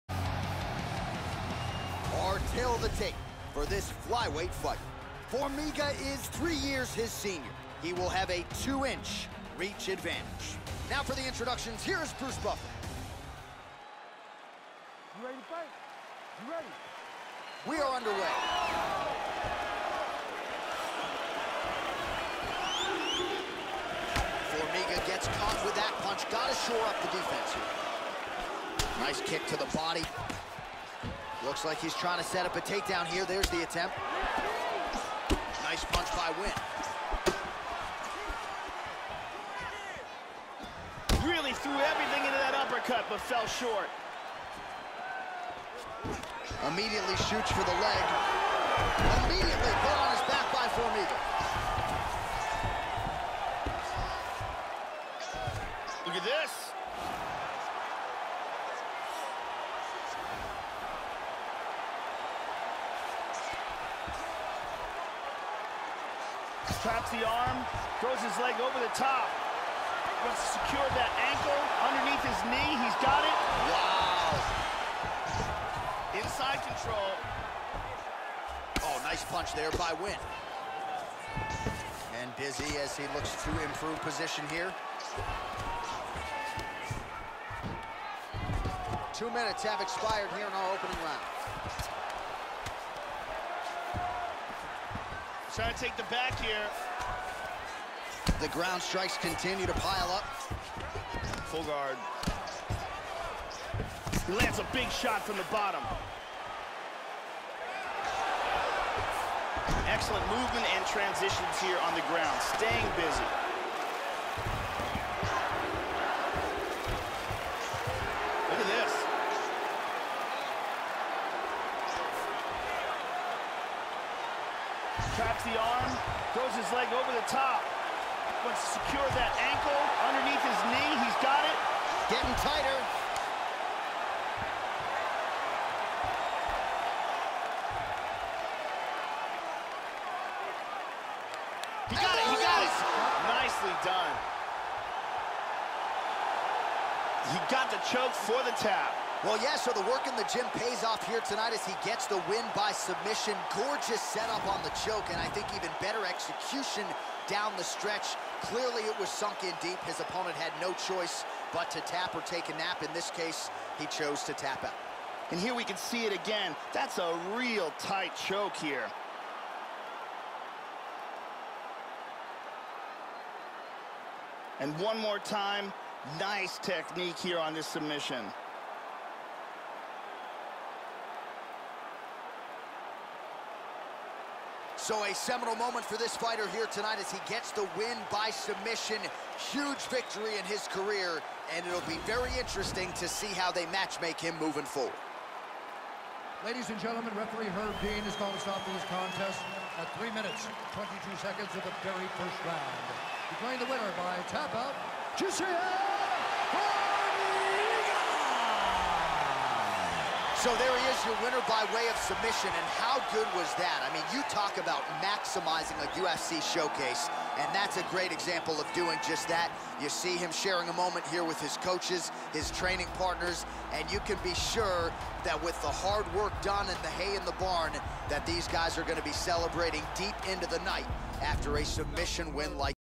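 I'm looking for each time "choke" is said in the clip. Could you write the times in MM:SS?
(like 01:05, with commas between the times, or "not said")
02:27, 02:34, 02:48.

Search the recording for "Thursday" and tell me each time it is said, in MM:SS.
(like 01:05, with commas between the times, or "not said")
not said.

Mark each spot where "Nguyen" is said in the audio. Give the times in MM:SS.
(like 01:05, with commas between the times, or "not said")
00:36, 01:19.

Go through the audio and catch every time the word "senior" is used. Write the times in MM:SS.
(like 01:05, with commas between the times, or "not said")
00:07.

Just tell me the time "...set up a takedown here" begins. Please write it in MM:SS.
00:32.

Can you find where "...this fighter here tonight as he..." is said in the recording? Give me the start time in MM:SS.
03:05.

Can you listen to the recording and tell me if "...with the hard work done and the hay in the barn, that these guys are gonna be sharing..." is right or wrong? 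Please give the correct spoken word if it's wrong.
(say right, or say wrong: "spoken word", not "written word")
wrong: "celebrating", not "sharing".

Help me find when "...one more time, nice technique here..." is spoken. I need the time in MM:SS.
02:54.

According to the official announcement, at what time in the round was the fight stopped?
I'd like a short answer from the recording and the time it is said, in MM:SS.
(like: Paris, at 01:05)
3:22, at 03:19.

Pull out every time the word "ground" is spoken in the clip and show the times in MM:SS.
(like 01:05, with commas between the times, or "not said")
01:38, 01:52.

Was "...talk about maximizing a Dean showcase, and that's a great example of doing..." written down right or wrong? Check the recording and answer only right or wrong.
wrong.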